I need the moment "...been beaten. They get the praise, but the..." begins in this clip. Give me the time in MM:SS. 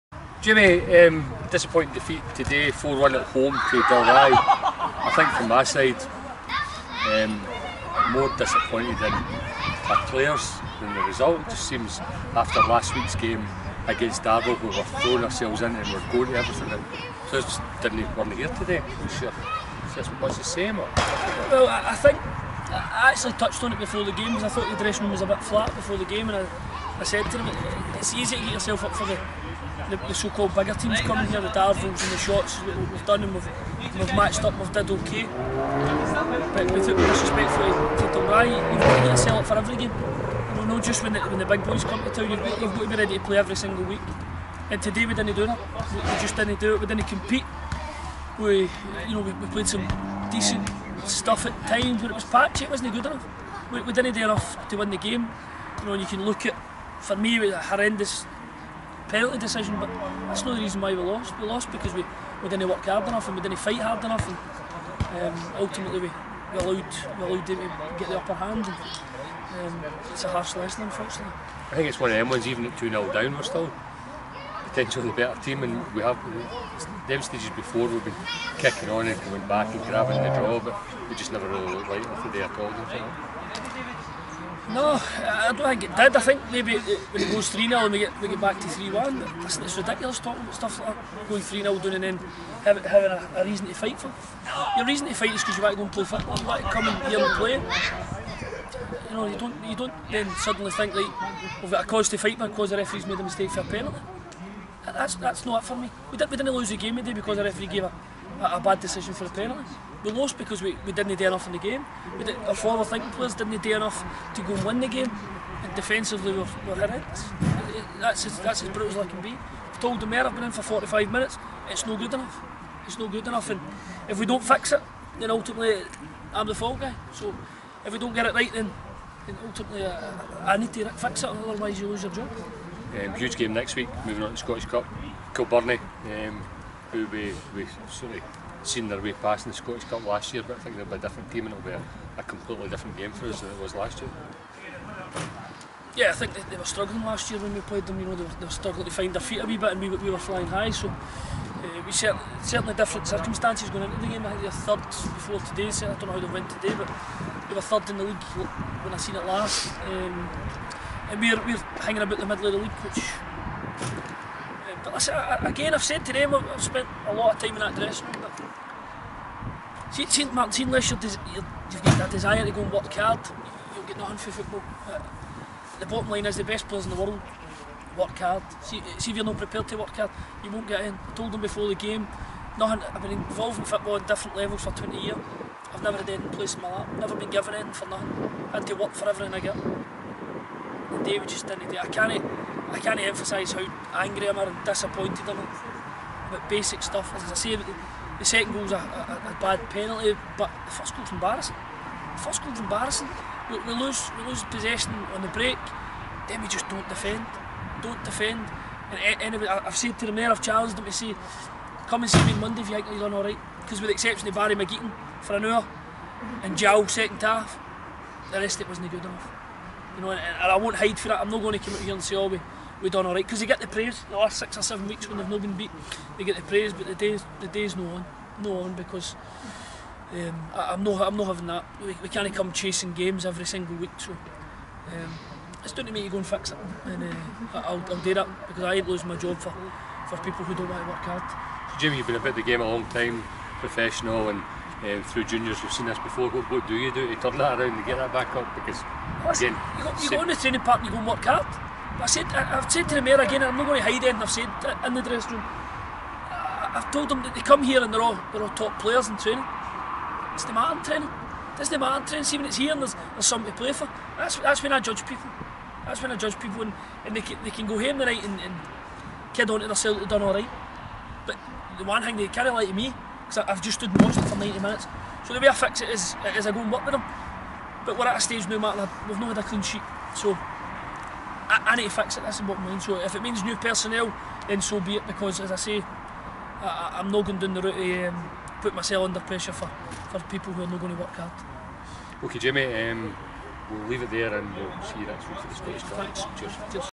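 03:45.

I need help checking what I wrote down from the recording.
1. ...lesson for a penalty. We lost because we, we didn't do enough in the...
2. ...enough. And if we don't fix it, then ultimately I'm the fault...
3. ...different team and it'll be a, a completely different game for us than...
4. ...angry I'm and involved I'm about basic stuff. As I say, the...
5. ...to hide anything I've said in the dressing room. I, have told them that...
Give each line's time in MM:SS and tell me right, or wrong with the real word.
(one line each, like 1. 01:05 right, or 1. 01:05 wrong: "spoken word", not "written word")
1. 01:48 wrong: "decision", not "lesson"
2. 02:03 right
3. 02:20 right
4. 03:13 wrong: "disappointed", not "involved"
5. 04:13 right.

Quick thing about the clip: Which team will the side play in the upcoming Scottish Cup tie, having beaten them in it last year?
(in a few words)
Kilbirnie.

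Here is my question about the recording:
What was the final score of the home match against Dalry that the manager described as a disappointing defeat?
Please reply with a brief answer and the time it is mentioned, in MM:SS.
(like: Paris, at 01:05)
4-1, at 00:02.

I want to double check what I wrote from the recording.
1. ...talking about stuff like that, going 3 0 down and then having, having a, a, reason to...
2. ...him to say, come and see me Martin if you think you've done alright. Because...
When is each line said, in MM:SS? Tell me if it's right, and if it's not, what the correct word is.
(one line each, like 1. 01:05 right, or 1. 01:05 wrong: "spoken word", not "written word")
1. 01:30 right
2. 03:30 wrong: "Monday", not "Martin".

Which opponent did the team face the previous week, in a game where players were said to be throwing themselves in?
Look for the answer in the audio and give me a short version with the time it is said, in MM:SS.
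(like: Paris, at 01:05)
Darvel, at 00:14.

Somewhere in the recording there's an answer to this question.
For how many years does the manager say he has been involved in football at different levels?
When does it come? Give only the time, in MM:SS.
03:04.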